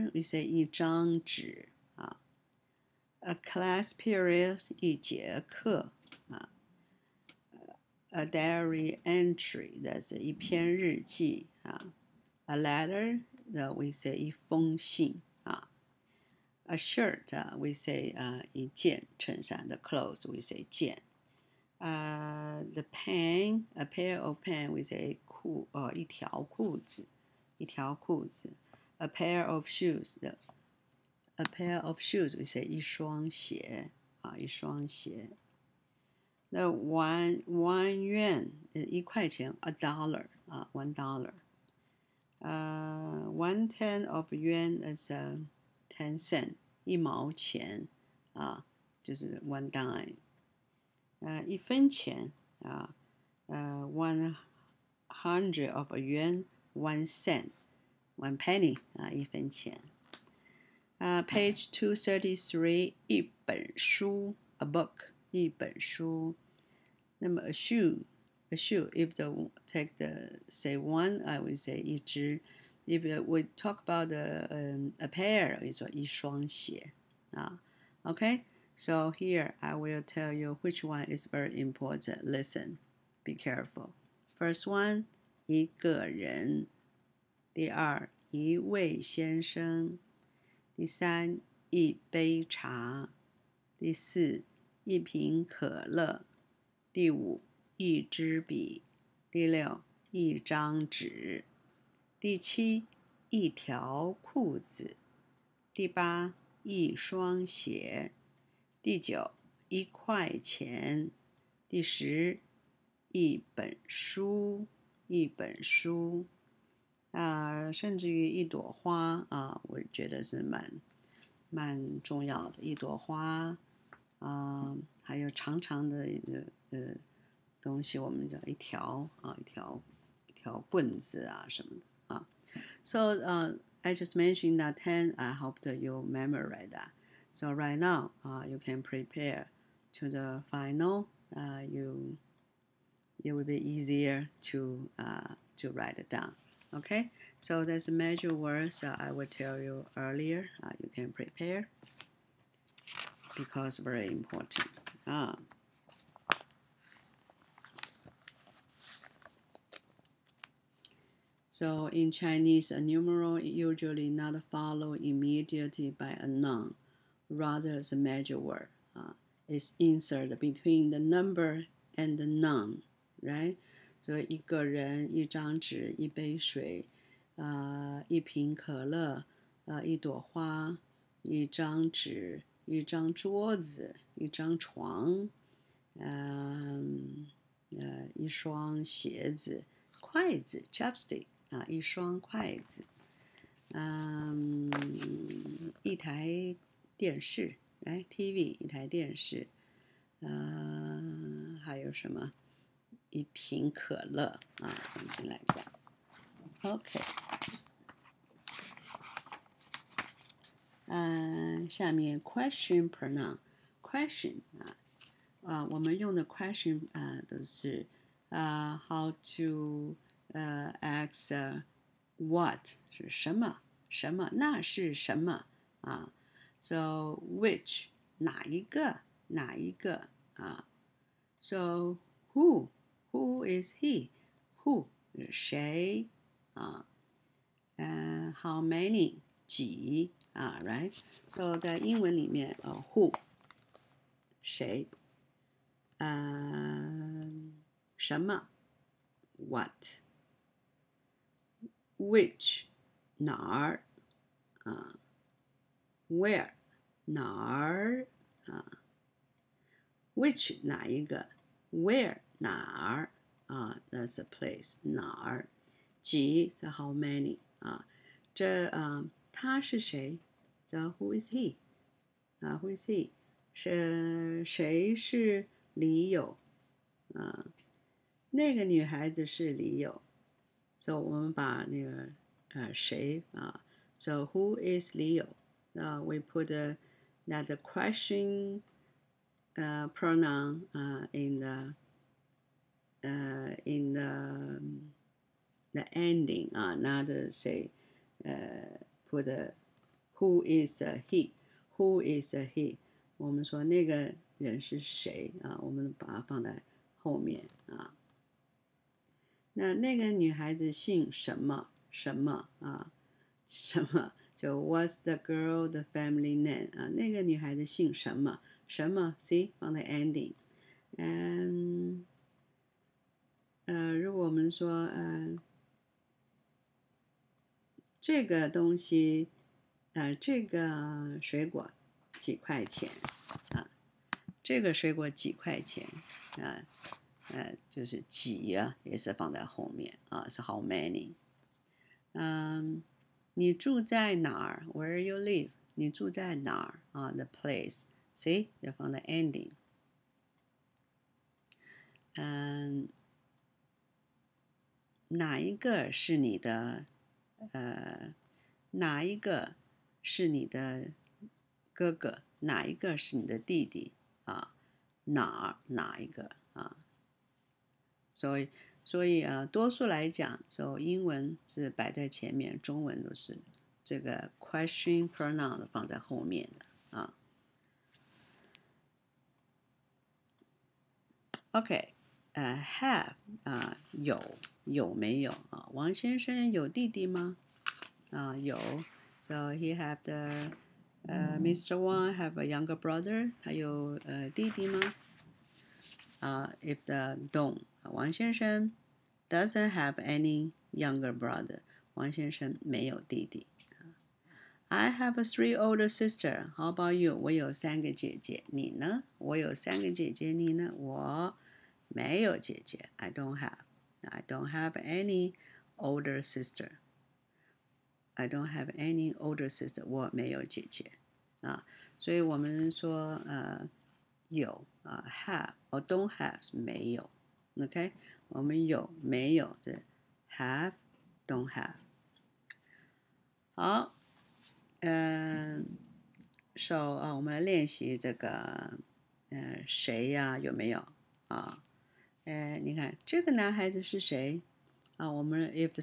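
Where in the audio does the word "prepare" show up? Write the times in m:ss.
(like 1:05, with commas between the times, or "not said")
2:18, 2:31.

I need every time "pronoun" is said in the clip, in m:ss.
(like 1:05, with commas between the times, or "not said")
3:32, 4:49, 6:15.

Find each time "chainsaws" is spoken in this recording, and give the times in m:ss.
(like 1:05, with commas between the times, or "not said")
not said.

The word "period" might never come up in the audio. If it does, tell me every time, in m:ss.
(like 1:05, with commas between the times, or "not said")
0:03.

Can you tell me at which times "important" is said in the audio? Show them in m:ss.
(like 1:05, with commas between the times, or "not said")
1:21, 2:34.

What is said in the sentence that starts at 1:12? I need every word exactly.
If we talk about the, um, a pair, it's 一 双 鞋.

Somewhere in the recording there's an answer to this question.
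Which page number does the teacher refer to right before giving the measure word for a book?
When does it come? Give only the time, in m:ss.
1:01.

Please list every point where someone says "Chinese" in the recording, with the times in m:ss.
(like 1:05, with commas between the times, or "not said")
2:42.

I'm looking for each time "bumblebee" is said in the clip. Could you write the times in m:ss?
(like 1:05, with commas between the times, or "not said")
not said.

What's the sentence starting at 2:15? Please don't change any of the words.
I hope that you memorize that.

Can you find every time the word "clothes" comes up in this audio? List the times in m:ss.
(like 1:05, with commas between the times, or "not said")
0:19.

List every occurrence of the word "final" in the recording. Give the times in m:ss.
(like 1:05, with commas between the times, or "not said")
2:20.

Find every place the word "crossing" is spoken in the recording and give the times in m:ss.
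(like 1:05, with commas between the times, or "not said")
not said.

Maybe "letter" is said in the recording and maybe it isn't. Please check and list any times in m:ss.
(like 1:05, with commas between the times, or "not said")
0:12.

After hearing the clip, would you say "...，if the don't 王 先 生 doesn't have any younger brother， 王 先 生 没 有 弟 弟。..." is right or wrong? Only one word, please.
right.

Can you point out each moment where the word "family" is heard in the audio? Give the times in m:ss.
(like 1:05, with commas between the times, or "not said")
5:15.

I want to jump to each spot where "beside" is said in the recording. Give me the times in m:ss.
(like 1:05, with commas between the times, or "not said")
not said.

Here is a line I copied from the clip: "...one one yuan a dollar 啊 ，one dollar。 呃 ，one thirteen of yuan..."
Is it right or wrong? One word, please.
wrong.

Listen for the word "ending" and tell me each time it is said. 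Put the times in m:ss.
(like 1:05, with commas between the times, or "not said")
4:55, 5:19, 5:49.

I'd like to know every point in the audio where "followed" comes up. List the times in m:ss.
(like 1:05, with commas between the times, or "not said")
2:44.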